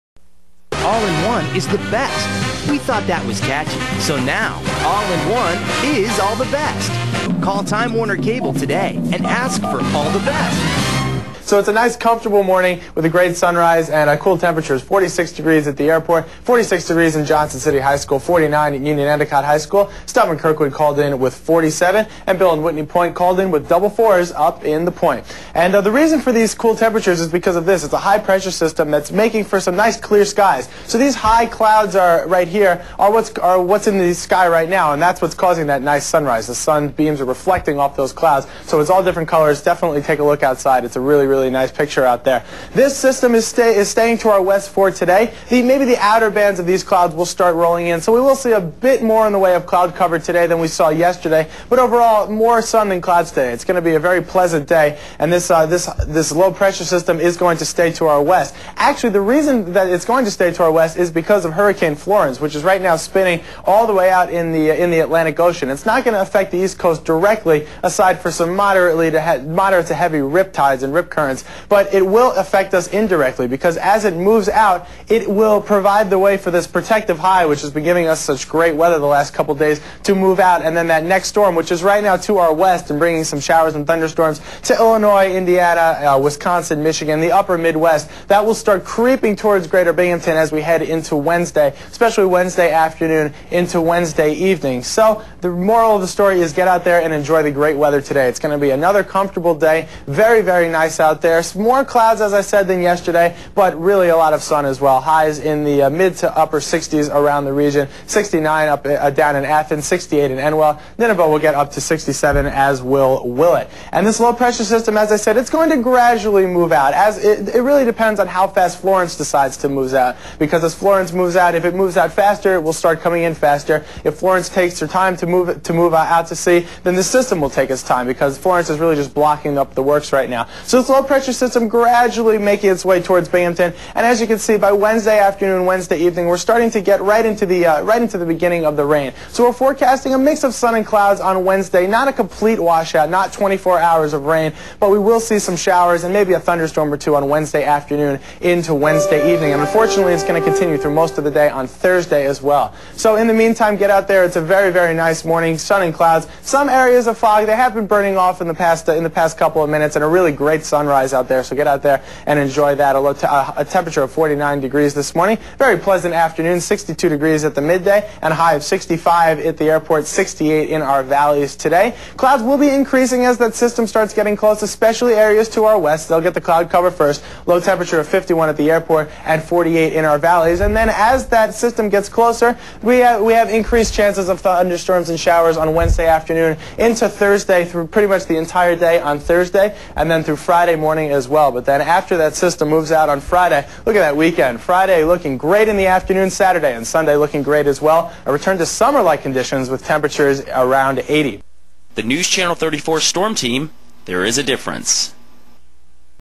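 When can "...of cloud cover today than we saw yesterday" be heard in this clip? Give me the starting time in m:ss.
0:49.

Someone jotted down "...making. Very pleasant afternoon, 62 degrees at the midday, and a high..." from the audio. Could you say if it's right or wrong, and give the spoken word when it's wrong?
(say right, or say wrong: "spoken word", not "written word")
wrong: "morning", not "making".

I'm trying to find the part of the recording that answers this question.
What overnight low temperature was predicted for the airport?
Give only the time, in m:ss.
2:57.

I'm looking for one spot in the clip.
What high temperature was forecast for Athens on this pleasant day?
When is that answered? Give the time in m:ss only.
1:48.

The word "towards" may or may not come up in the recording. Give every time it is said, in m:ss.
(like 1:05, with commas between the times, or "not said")
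1:29, 2:13.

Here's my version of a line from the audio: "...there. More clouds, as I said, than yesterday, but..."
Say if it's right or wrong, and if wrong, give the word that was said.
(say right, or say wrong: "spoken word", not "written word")
right.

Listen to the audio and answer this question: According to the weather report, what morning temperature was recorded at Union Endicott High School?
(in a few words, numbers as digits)
49.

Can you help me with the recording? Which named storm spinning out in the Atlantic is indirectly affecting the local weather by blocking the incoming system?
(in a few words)
Hurricane Florence.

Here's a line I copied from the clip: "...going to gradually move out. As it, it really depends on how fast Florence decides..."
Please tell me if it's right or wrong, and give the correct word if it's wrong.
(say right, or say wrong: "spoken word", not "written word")
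right.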